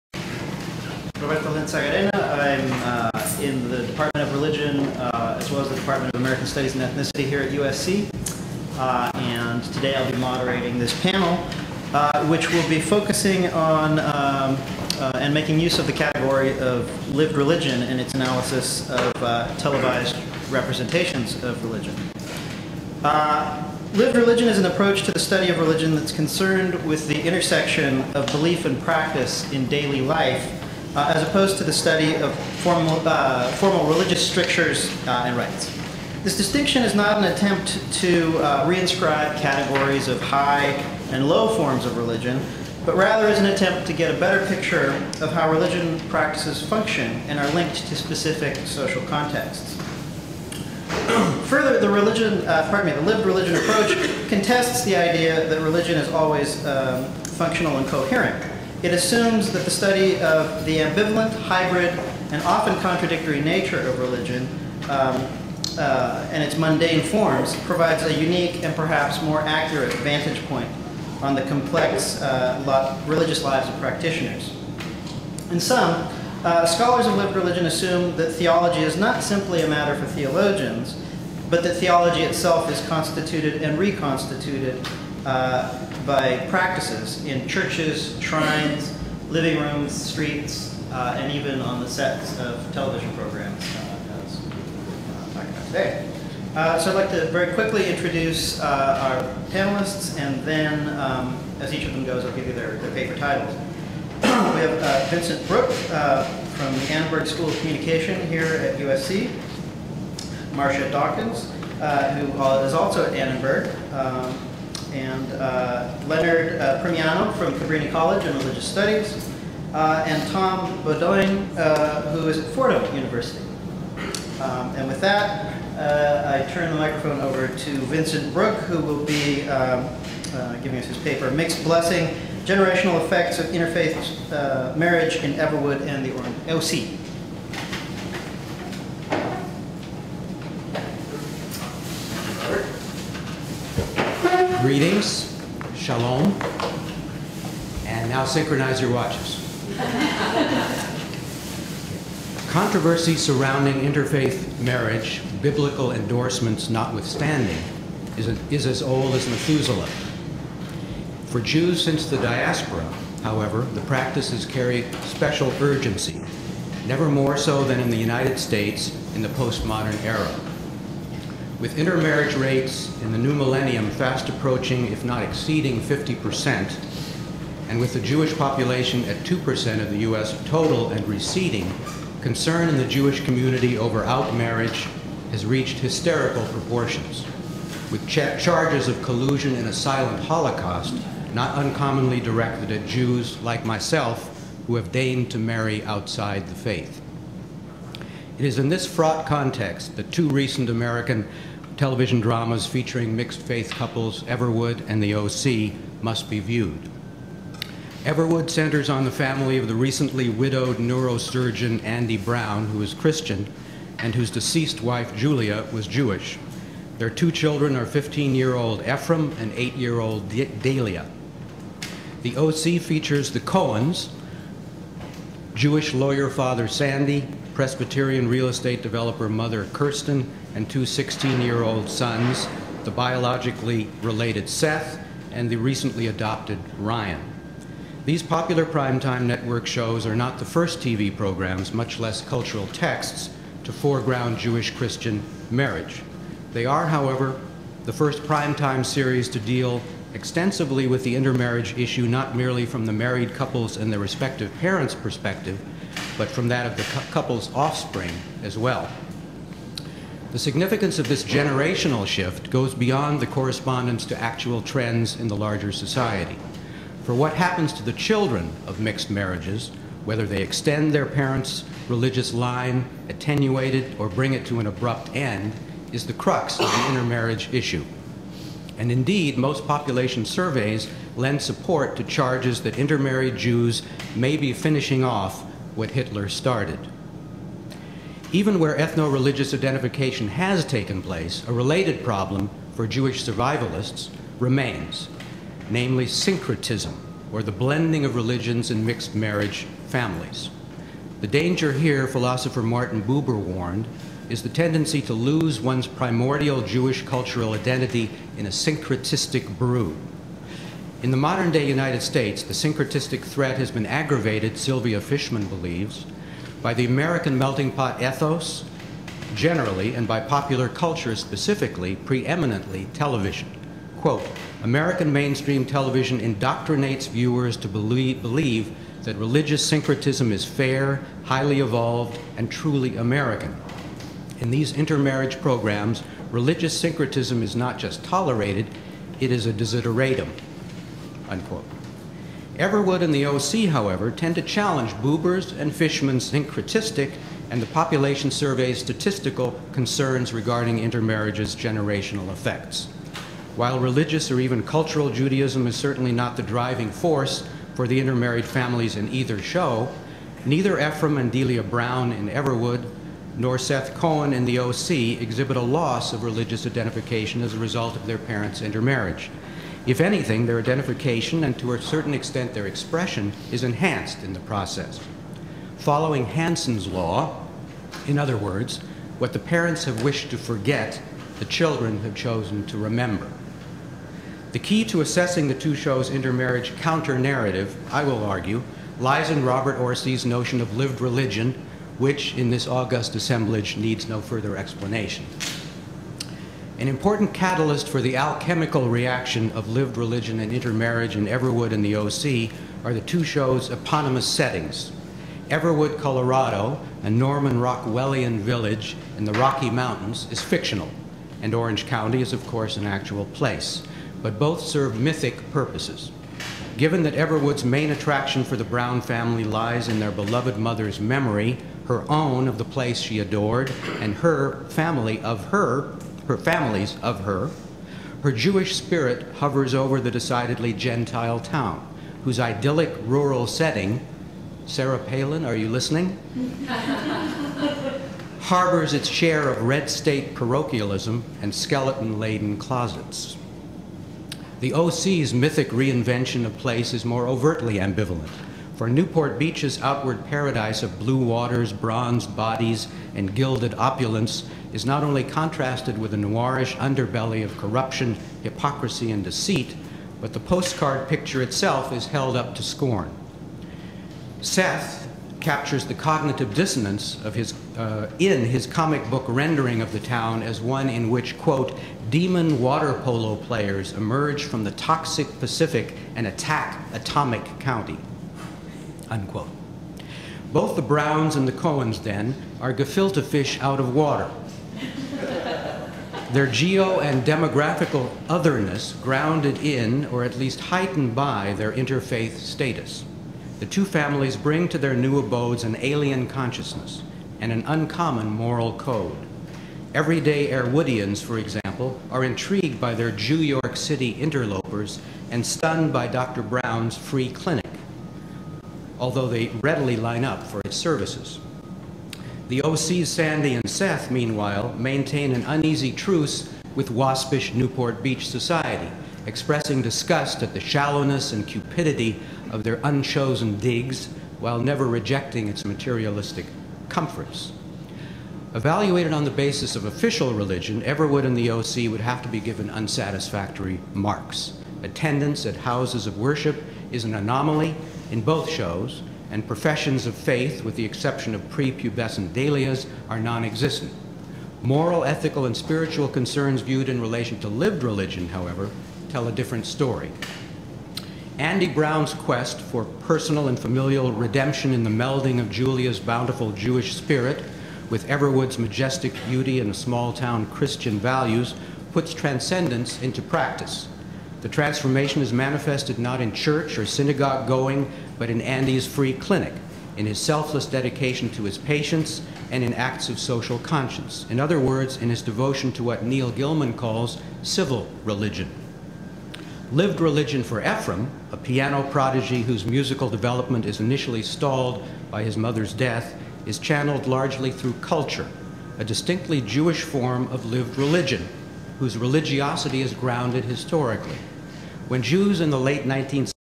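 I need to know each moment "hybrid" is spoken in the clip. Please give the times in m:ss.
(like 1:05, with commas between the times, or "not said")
1:01.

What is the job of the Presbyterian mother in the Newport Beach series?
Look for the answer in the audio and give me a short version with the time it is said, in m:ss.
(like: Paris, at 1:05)
real estate developer, at 3:48.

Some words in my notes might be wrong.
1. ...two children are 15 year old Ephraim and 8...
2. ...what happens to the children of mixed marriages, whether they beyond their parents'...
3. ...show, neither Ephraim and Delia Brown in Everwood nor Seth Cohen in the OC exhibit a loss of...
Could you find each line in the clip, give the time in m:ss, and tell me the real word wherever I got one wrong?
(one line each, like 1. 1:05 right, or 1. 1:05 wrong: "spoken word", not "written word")
1. 3:37 right
2. 4:27 wrong: "extend", not "beyond"
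3. 5:59 right.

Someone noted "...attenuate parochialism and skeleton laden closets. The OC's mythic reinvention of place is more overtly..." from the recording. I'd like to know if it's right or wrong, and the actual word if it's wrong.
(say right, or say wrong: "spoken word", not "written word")
wrong: "state", not "attenuate".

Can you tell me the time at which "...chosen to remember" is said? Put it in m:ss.
6:22.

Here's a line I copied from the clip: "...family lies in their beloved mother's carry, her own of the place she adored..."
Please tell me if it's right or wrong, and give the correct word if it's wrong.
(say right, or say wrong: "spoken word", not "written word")
wrong: "memory", not "carry".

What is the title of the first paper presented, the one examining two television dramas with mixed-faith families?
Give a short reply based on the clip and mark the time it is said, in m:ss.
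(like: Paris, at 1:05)
Mixed Blessing, at 2:11.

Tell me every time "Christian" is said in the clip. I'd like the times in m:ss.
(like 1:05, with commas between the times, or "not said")
3:32, 4:04, 9:20.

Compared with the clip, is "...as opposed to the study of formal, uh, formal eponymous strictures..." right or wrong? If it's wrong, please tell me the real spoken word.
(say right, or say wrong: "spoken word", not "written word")
wrong: "religious", not "eponymous".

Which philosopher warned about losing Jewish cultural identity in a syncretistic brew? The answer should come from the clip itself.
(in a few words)
Martin Buber.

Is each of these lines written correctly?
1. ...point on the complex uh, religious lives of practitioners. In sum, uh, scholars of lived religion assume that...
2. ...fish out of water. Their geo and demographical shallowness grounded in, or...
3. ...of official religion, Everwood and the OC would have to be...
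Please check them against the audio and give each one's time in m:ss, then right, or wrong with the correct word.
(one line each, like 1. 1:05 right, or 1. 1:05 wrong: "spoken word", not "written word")
1. 1:10 right
2. 8:03 wrong: "otherness", not "shallowness"
3. 8:49 right.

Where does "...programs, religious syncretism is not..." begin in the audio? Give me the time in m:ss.
5:35.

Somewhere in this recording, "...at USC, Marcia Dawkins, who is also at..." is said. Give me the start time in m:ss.
1:48.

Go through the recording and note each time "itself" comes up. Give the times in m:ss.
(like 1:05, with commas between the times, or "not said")
1:22, 7:41.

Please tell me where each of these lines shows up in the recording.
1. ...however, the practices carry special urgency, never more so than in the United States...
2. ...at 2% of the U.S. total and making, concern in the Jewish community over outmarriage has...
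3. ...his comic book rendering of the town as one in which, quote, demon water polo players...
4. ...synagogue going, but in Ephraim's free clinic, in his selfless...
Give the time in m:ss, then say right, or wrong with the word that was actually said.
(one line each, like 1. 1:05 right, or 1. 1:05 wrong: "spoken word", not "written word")
1. 2:43 right
2. 2:59 wrong: "receding", not "making"
3. 7:48 right
4. 9:26 wrong: "Andy", not "Ephraim".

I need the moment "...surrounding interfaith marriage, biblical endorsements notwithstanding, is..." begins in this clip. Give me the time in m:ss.
2:33.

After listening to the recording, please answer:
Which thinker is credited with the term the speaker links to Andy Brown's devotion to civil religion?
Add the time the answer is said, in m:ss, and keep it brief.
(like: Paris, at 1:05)
Neil Gillman, at 9:36.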